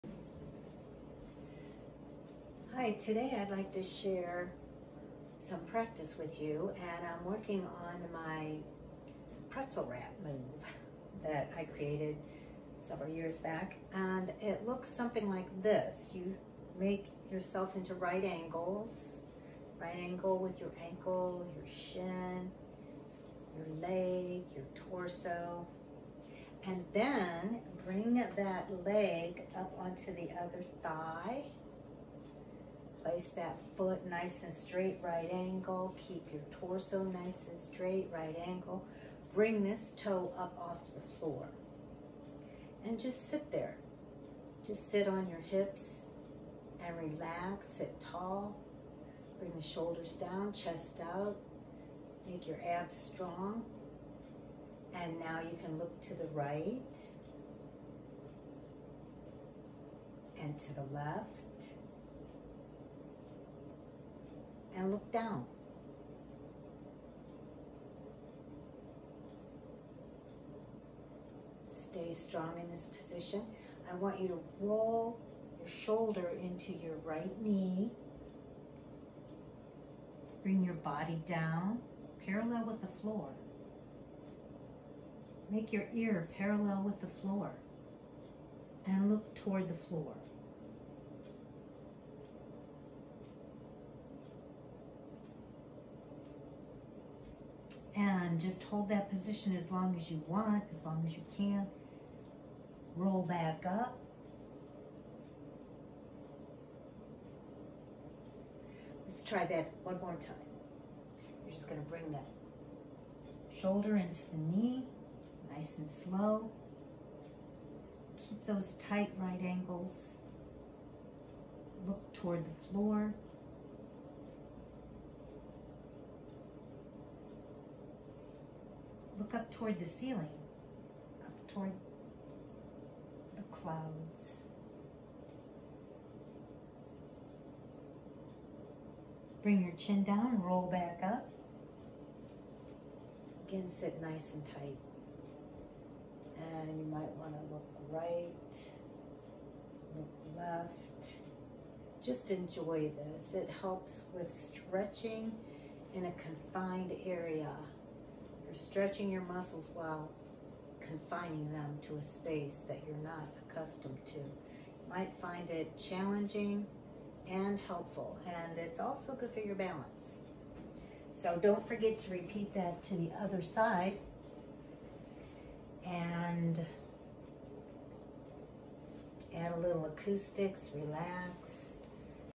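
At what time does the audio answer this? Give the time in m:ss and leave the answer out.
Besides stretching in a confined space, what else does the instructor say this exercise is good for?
2:49.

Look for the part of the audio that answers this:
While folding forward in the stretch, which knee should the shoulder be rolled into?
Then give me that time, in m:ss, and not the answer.
1:17.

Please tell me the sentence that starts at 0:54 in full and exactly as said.
And now you can look to the right and to the left and look down.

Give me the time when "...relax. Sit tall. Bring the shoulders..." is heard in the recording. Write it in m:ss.
0:46.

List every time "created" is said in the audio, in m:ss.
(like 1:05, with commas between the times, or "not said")
0:11.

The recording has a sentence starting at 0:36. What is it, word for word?
Keep your torso nice and straight, right angle.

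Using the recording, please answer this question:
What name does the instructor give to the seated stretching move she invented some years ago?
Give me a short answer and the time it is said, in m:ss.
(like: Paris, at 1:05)
pretzel wrap, at 0:09.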